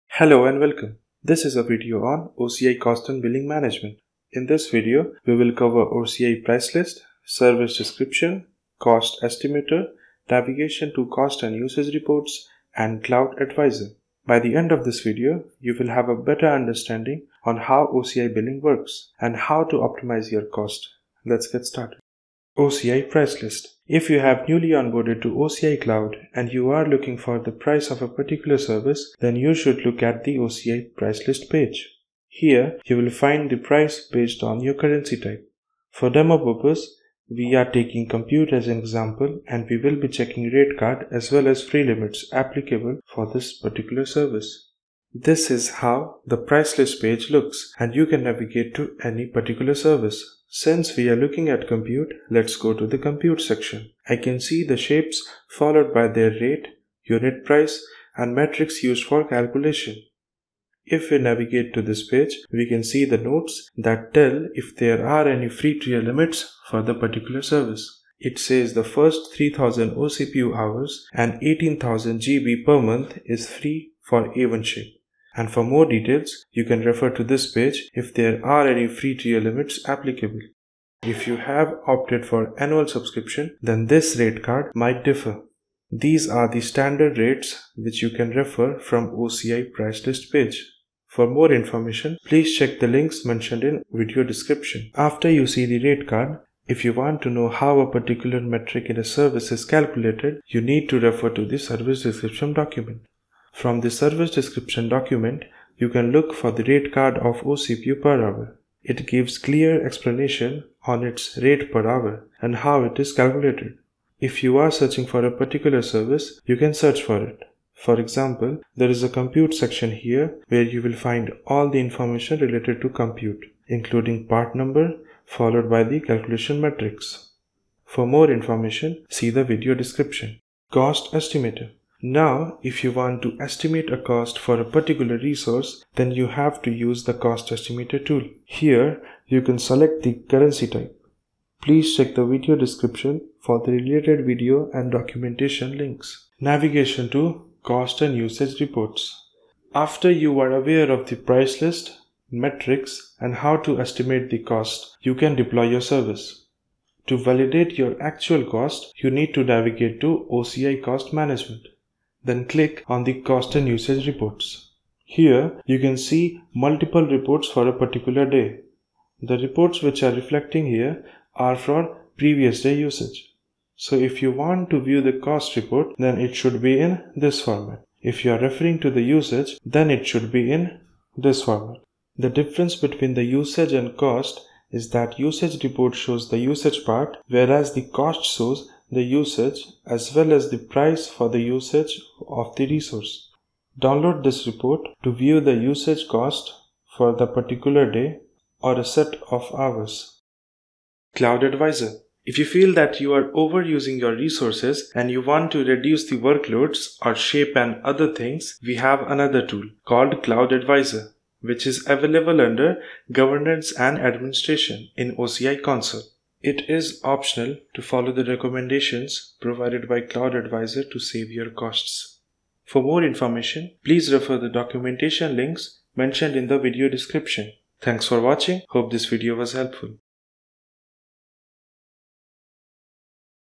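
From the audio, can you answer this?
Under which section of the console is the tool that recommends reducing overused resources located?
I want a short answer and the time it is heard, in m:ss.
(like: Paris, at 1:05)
Governance and Administration, at 3:33.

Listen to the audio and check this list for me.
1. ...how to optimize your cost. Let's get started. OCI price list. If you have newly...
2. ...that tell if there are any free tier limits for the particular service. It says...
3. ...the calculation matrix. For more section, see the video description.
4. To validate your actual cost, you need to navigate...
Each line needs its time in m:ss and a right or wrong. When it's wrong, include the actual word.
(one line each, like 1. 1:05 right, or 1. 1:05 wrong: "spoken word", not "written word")
1. 0:19 right
2. 1:03 right
3. 2:05 wrong: "information", not "section"
4. 2:37 right.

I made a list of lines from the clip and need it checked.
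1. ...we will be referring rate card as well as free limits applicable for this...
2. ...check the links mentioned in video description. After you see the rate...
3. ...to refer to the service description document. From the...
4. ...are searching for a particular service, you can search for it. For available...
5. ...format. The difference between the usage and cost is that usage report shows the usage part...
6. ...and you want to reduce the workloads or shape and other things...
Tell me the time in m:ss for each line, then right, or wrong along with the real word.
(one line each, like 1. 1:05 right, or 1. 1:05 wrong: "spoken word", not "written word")
1. 0:39 wrong: "checking", not "referring"
2. 1:32 right
3. 1:40 right
4. 1:54 wrong: "example", not "available"
5. 3:01 right
6. 3:24 right.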